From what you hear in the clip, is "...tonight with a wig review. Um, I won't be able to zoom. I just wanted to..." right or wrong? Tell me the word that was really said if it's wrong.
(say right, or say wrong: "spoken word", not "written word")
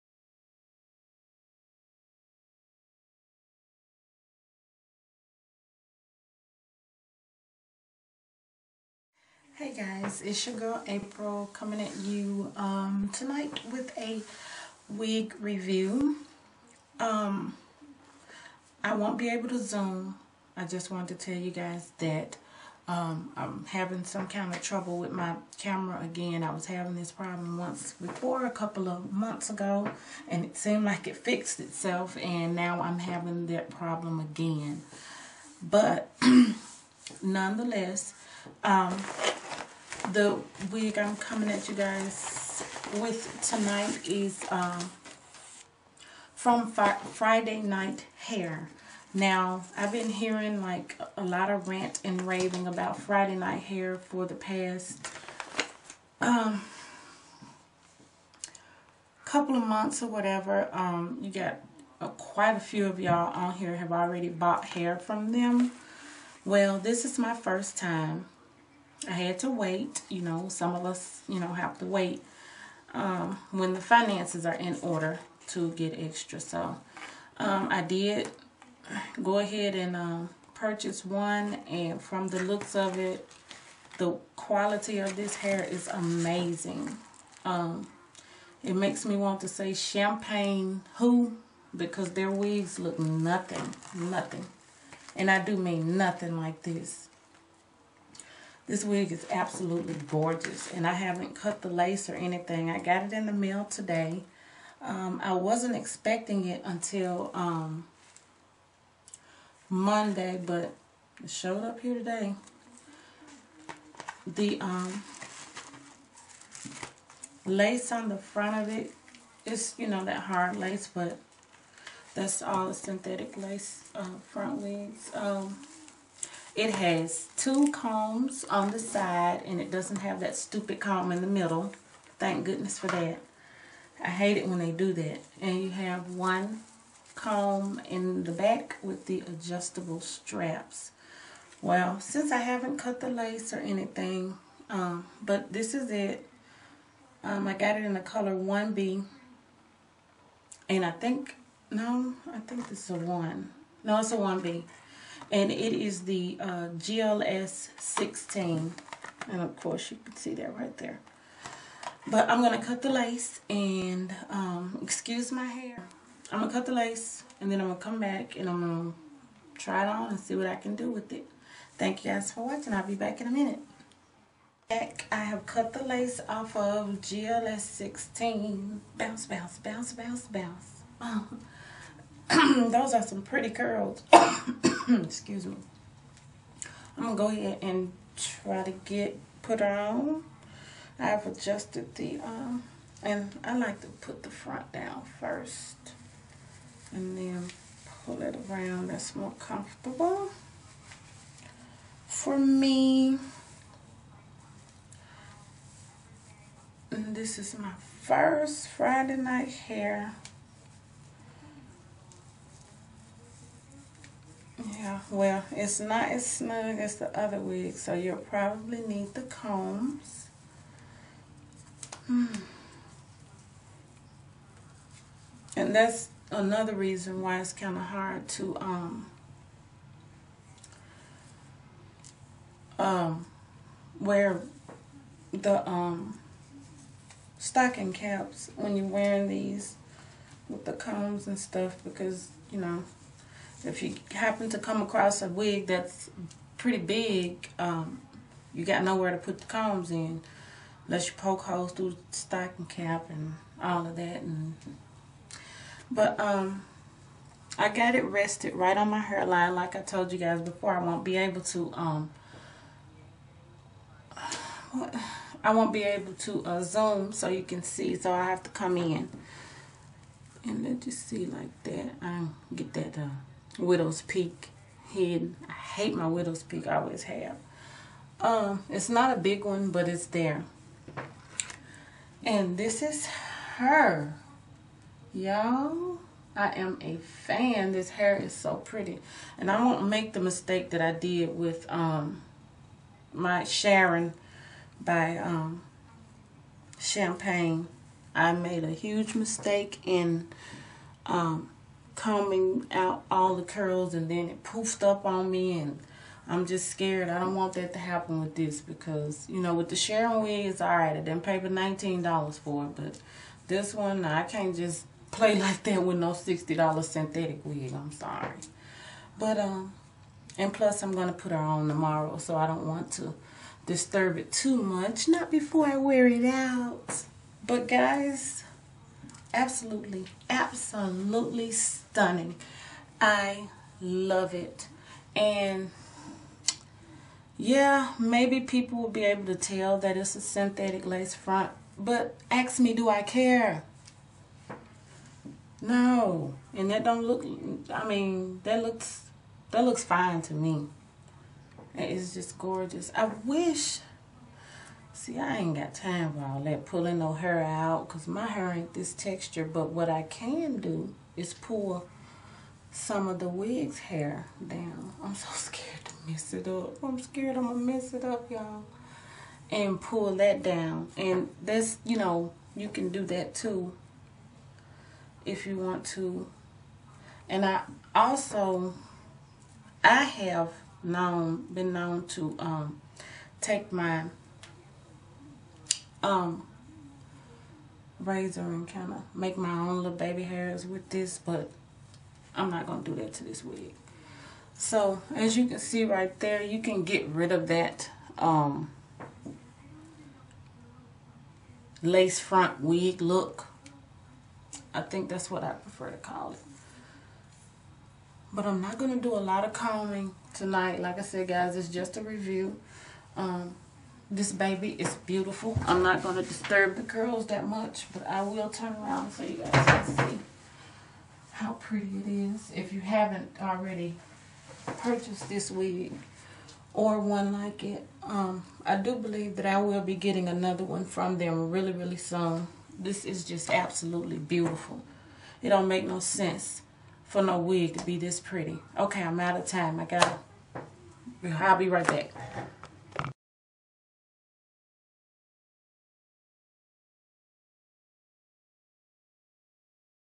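right.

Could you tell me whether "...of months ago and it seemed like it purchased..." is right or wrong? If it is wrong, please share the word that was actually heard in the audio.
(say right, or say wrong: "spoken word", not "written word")
wrong: "fixed", not "purchased".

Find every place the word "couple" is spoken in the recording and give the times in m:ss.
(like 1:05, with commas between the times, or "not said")
0:28, 0:59.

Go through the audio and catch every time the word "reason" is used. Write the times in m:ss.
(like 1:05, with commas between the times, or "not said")
3:46.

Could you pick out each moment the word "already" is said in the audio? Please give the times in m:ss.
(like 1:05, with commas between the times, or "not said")
1:03, 7:03.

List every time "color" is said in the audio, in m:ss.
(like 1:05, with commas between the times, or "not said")
2:28.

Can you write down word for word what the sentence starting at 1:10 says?
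You know, some of us, you know, have to wait um, when the finances are in order to get extra.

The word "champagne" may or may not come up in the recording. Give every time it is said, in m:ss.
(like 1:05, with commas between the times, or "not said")
1:29, 4:56.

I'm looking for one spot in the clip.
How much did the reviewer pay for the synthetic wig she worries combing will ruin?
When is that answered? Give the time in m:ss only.
5:16.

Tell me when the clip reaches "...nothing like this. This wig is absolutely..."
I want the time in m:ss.
1:35.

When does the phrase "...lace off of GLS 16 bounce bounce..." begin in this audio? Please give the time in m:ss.
2:55.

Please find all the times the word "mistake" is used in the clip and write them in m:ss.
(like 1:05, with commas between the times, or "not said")
4:50, 4:59.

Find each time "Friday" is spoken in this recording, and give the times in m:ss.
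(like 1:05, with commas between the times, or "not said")
0:46, 0:52, 3:28.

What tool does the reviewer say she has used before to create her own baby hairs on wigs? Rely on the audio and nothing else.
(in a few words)
razor.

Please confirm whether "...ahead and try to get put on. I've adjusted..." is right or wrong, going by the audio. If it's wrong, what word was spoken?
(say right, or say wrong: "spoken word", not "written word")
right.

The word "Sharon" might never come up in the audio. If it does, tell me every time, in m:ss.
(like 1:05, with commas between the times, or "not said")
4:53, 5:09.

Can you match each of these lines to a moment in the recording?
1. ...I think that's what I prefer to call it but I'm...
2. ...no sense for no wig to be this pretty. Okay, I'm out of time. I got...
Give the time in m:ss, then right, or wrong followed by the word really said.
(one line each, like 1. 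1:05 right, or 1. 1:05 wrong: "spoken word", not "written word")
1. 6:44 right
2. 7:15 right.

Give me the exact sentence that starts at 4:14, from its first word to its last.
And But um, I got it rested right on my hairline like I told you guys before.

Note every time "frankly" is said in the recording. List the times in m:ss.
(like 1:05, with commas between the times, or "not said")
not said.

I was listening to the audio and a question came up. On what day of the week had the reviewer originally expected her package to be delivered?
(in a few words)
Monday.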